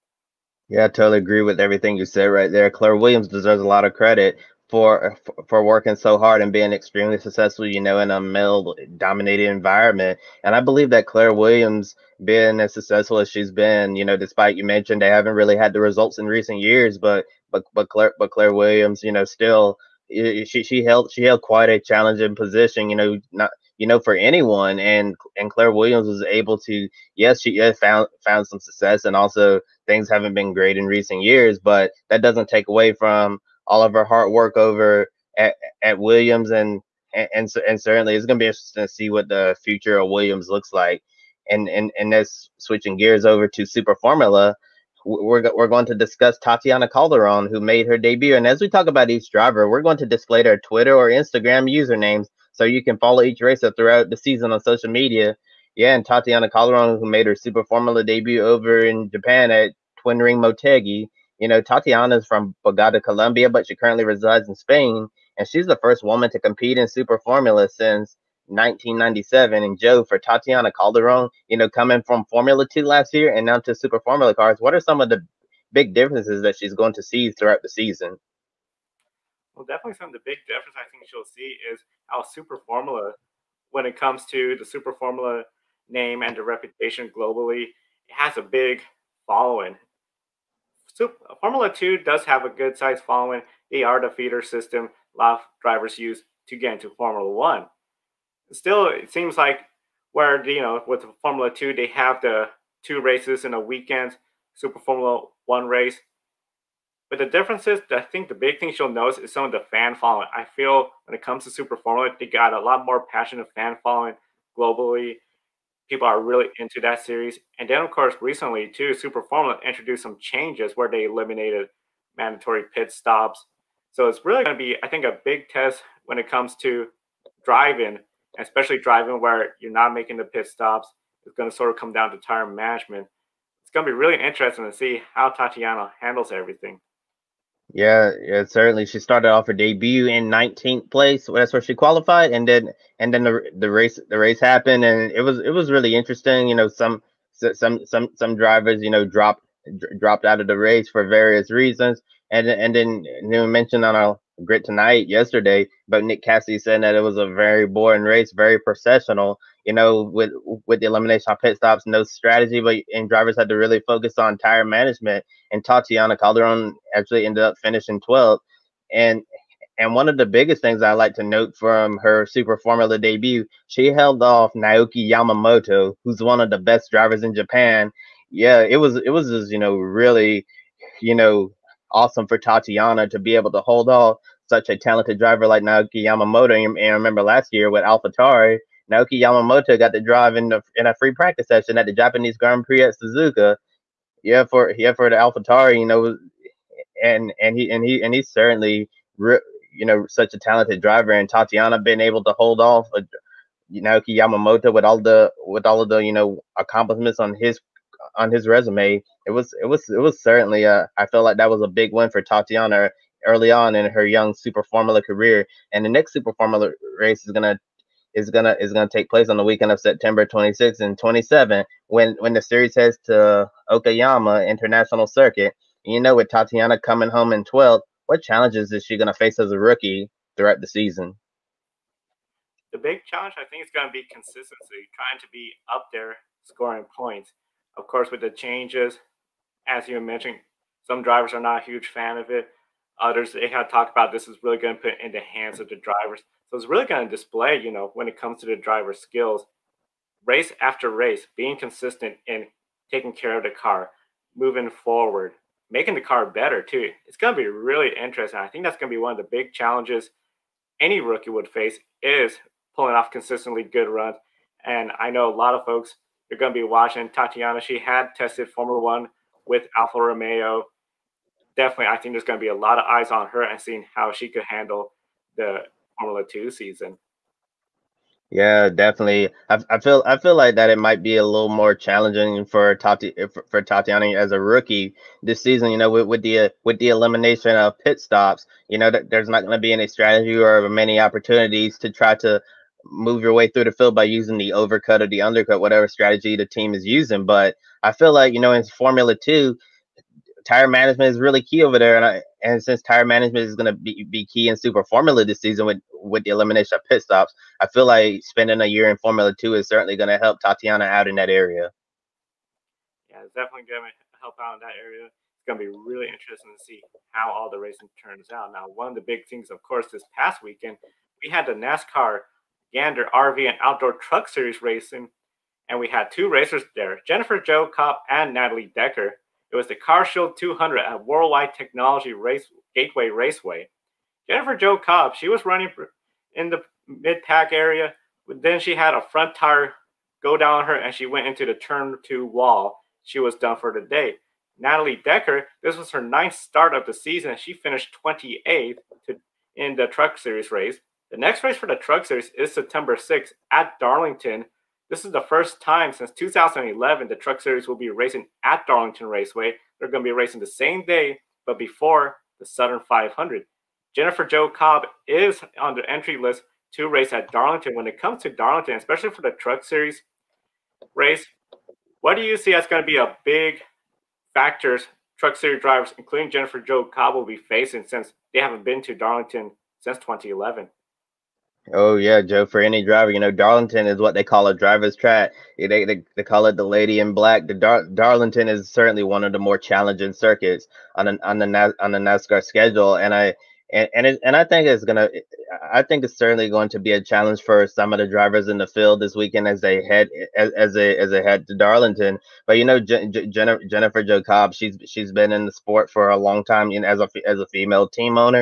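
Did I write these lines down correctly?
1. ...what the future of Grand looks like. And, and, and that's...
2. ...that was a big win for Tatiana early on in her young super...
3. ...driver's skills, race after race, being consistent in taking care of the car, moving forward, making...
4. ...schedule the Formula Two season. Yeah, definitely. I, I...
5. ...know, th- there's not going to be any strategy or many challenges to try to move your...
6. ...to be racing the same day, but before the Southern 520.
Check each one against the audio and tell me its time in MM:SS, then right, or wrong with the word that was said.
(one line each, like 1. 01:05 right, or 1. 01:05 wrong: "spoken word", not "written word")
1. 00:39 wrong: "Williams", not "Grand"
2. 03:31 right
3. 04:08 right
4. 04:34 wrong: "handle", not "schedule"
5. 04:48 wrong: "opportunities", not "challenges"
6. 06:00 wrong: "500", not "520".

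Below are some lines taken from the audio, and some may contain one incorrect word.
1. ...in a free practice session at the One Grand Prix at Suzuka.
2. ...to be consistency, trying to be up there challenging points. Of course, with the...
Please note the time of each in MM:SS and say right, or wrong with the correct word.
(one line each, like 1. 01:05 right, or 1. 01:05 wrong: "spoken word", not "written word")
1. 03:10 wrong: "Japanese", not "One"
2. 03:53 wrong: "scoring", not "challenging".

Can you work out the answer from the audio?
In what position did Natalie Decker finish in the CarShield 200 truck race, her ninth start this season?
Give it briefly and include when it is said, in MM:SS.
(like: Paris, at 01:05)
28th, at 05:48.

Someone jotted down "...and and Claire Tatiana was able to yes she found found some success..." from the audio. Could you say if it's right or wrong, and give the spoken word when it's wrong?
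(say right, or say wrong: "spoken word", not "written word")
wrong: "Williams", not "Tatiana".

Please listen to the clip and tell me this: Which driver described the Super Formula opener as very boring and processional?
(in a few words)
Nick Cassidy.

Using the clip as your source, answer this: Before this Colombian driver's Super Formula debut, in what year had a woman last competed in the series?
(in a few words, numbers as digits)
1997.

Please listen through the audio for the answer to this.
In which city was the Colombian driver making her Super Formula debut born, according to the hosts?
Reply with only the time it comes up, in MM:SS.
01:02.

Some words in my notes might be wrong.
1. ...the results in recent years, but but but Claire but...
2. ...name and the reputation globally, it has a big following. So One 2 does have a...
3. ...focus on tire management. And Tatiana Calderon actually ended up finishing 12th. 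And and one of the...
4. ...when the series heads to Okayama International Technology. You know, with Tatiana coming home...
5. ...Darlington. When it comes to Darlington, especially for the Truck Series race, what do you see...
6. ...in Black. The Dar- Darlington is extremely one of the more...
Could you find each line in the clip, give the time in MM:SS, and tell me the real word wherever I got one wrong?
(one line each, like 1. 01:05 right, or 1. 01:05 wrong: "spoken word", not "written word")
1. 00:15 right
2. 01:25 wrong: "Formula", not "One"
3. 02:43 right
4. 03:42 wrong: "Circuit", not "Technology"
5. 06:07 right
6. 06:26 wrong: "certainly", not "extremely".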